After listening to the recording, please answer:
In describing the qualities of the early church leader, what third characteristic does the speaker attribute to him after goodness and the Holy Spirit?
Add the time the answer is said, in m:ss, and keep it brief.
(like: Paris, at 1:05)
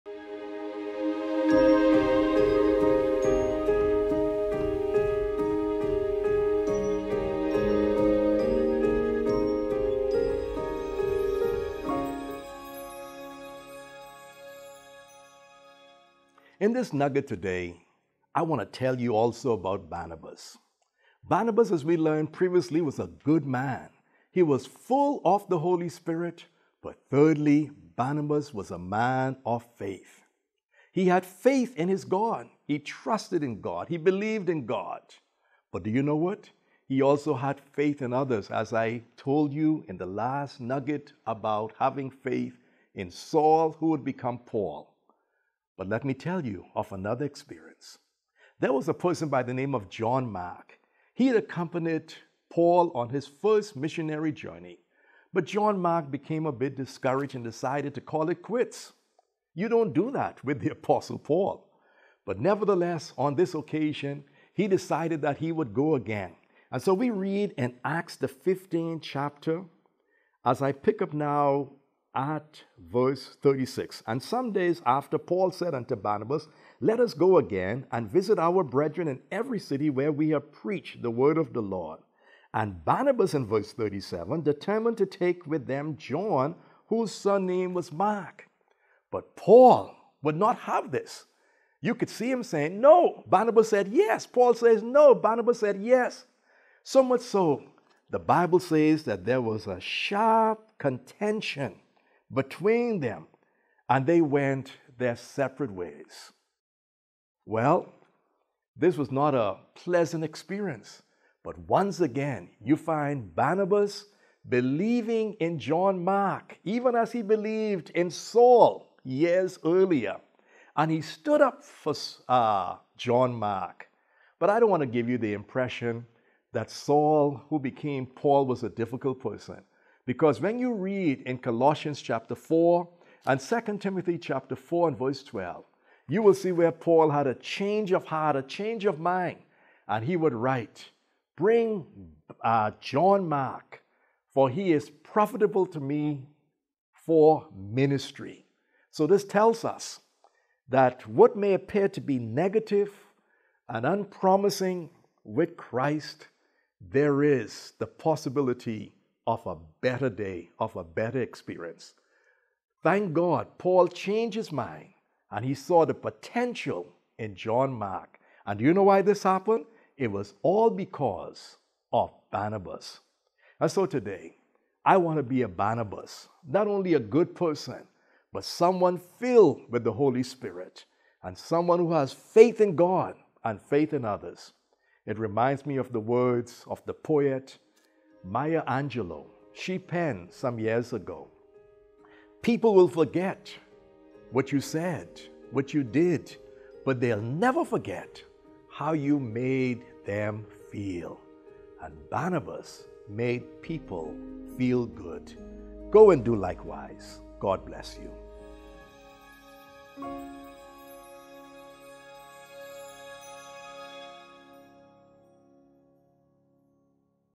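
A man of faith, at 0:28.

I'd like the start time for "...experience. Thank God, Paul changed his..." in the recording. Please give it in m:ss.
2:41.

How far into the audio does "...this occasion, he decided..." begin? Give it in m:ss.
1:03.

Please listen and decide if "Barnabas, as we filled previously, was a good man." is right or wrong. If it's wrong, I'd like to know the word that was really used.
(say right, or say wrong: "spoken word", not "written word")
wrong: "learned", not "filled".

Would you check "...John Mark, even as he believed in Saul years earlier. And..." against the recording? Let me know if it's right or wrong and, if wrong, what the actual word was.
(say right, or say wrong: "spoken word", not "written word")
right.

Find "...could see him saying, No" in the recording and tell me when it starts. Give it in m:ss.
1:31.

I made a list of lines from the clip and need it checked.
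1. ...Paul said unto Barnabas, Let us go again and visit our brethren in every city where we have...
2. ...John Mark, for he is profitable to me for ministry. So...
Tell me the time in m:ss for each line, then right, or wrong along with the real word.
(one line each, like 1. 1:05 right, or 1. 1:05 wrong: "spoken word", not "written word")
1. 1:15 right
2. 2:22 right.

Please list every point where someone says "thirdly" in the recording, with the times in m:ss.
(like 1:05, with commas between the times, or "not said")
0:27.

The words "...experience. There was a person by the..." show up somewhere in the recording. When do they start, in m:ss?
0:47.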